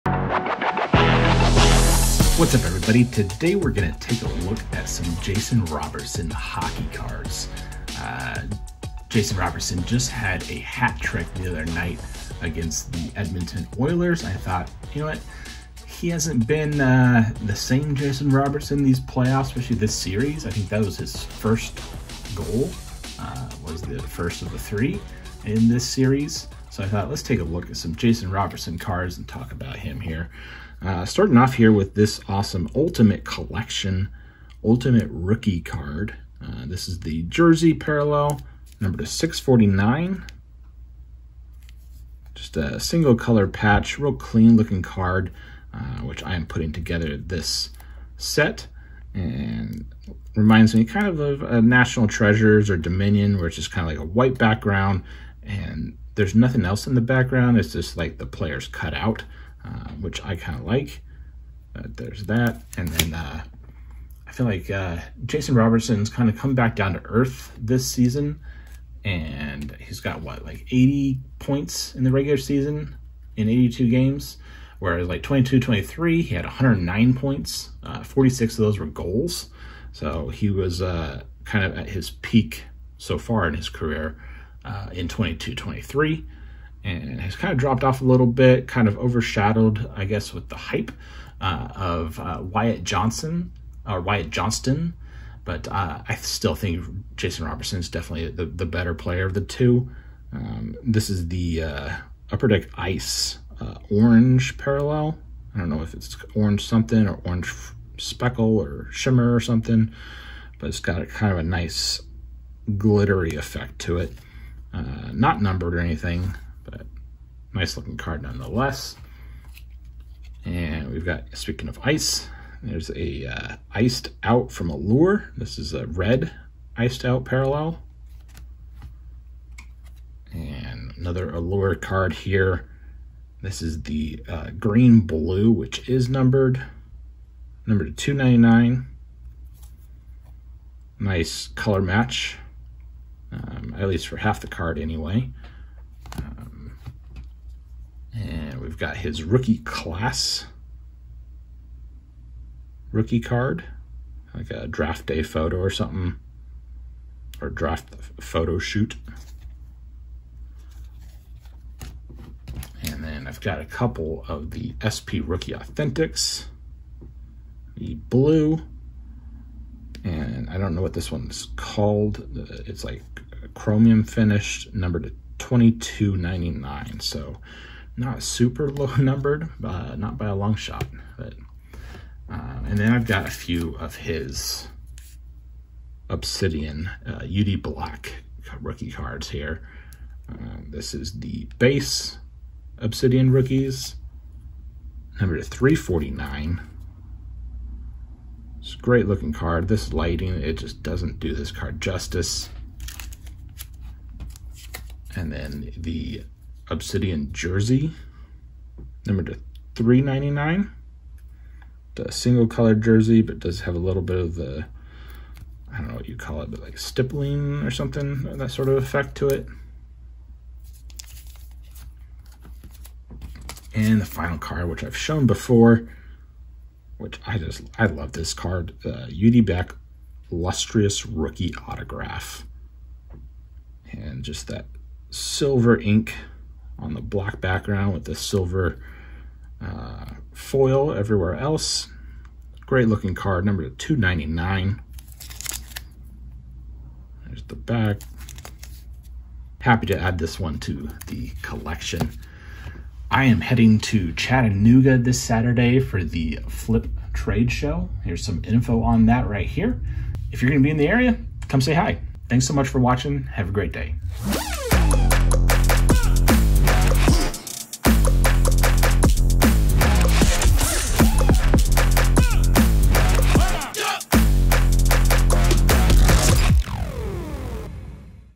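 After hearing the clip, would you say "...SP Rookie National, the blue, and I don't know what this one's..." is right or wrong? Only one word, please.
wrong.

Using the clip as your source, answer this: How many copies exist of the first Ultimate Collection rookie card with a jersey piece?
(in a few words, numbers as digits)
649.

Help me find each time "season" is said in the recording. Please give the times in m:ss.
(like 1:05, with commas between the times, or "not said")
1:07, 1:12.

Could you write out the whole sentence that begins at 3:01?
But um, and then I've got a few of his Obsidian uh, UD Black rookie cards here.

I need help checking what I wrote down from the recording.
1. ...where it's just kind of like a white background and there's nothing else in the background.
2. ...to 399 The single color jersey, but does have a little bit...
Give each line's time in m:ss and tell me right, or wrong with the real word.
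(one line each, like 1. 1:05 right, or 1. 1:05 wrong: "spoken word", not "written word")
1. 0:53 right
2. 3:29 right.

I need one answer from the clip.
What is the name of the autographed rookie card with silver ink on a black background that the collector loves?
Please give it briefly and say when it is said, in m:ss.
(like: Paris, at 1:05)
UD Black Lustrous Rookie Autograph, at 3:49.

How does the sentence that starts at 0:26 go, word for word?
So I thought, let's take a look at some Jason Robertson cards and talk about him here.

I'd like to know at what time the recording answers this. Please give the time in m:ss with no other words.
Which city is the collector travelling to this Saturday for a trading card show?
4:14.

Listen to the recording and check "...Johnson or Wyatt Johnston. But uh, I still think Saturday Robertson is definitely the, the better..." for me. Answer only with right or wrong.
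wrong.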